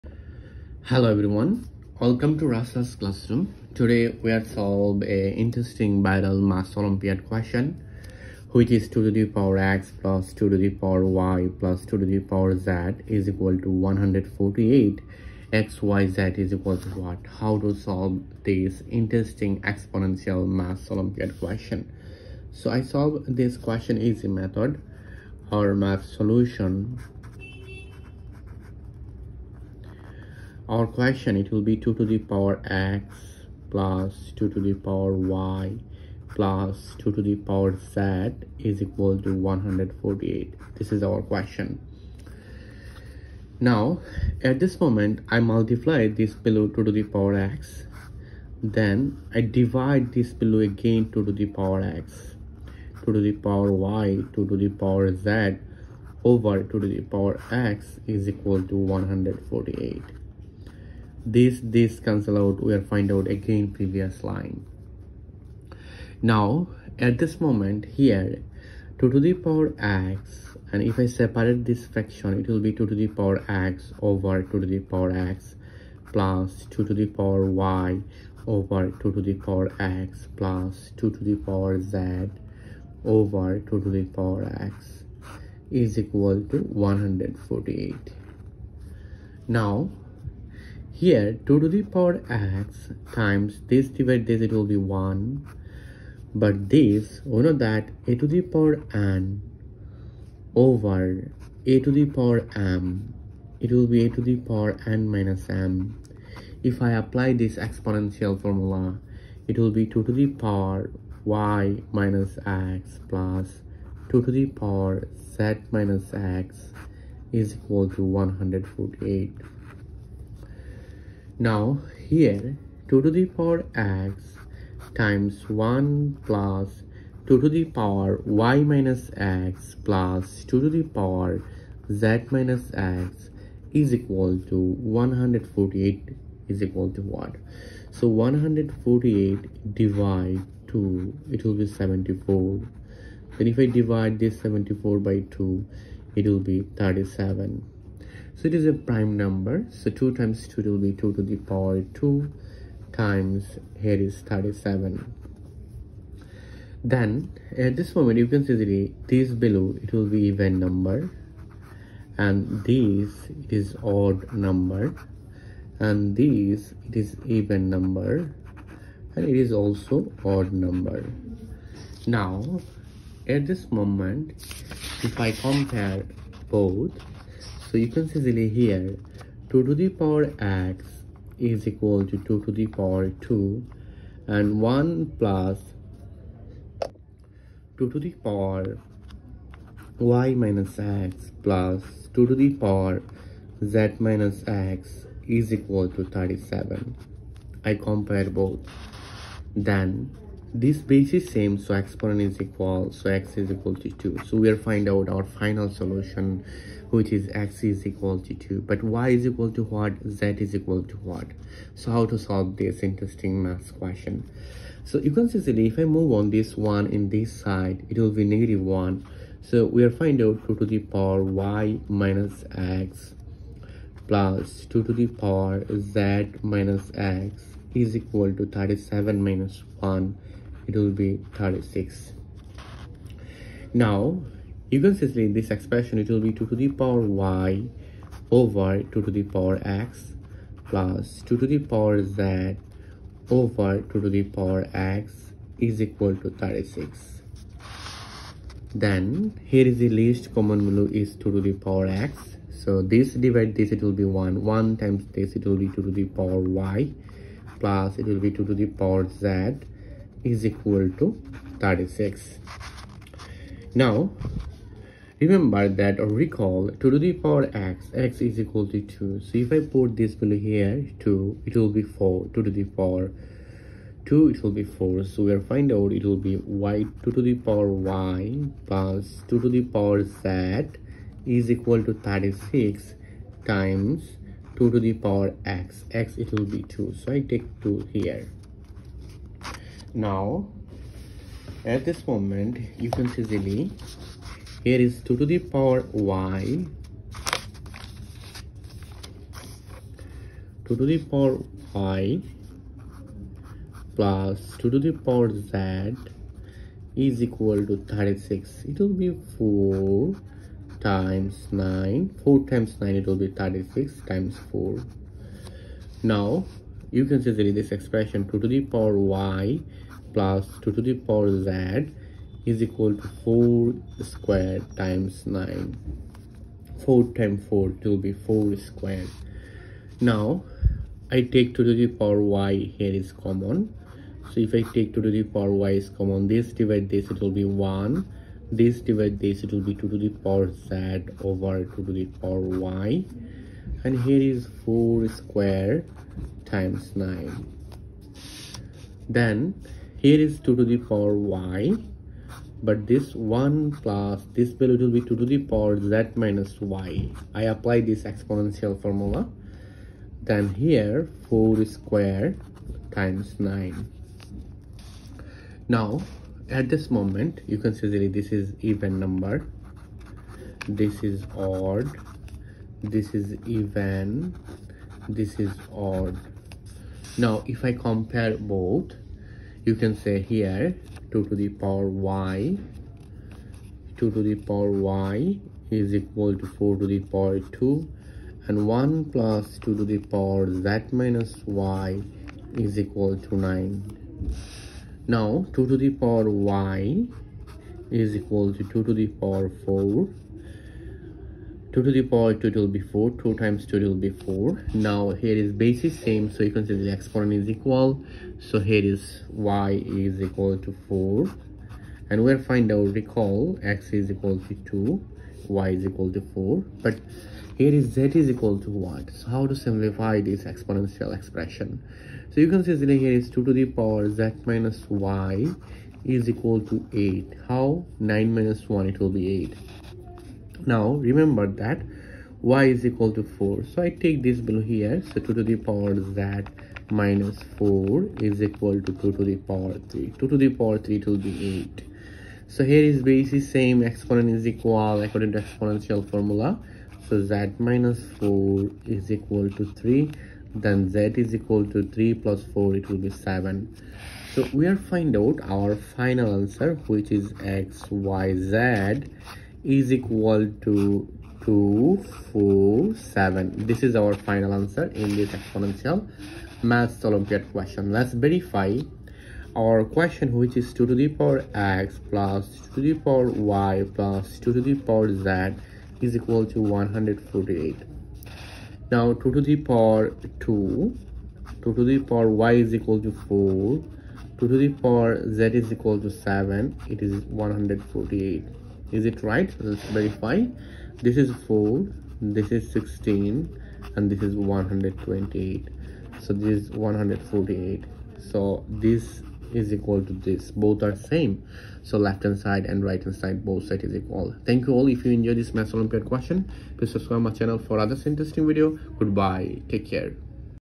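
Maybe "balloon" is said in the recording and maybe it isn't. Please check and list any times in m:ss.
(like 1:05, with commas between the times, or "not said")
not said.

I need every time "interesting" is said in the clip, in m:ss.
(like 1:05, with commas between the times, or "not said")
0:05, 0:18, 3:32, 8:28.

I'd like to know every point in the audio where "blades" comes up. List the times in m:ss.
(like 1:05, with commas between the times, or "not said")
not said.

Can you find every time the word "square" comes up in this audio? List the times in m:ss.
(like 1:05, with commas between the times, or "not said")
5:24, 5:28, 5:45, 6:01.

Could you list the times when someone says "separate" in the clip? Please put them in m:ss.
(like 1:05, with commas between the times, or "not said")
1:11.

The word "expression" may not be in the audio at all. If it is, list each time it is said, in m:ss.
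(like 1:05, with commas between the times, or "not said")
3:55, 5:17, 7:01.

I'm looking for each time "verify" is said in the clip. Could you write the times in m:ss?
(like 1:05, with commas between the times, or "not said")
7:48, 8:09.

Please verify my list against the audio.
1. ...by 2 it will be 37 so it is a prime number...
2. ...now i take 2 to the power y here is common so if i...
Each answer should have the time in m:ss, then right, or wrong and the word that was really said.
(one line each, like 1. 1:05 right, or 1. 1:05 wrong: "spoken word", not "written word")
1. 2:25 right
2. 5:30 right.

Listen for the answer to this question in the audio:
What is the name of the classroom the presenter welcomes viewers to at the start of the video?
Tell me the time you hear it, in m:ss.
0:02.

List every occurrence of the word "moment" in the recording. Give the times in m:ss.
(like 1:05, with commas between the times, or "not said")
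0:44, 1:07, 2:37, 2:53, 4:52, 6:06.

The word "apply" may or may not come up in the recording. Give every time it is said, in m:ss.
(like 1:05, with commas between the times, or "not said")
1:47, 5:57.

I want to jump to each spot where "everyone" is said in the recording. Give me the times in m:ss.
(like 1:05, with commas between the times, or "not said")
0:01.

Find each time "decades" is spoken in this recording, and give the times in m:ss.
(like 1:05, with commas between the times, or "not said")
not said.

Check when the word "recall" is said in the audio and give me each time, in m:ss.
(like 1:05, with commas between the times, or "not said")
4:26, 6:52.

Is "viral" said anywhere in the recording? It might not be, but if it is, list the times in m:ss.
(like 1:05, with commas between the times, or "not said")
0:06.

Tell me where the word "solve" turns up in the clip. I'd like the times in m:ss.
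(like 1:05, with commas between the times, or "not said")
0:04, 0:17, 0:22, 3:32.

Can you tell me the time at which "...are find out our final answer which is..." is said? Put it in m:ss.
7:34.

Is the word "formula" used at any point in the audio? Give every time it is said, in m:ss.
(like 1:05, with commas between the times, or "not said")
1:48, 5:58, 7:26.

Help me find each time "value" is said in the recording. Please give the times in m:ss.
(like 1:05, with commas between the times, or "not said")
4:10, 4:30, 5:54.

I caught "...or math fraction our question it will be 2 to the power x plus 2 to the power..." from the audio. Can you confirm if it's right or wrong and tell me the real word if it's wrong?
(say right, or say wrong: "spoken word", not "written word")
wrong: "solution", not "fraction".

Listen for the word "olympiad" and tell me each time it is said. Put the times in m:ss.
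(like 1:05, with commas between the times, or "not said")
0:06, 0:20, 7:47, 8:25.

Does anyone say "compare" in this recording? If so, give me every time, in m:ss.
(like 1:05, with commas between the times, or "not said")
2:55, 3:17, 6:17.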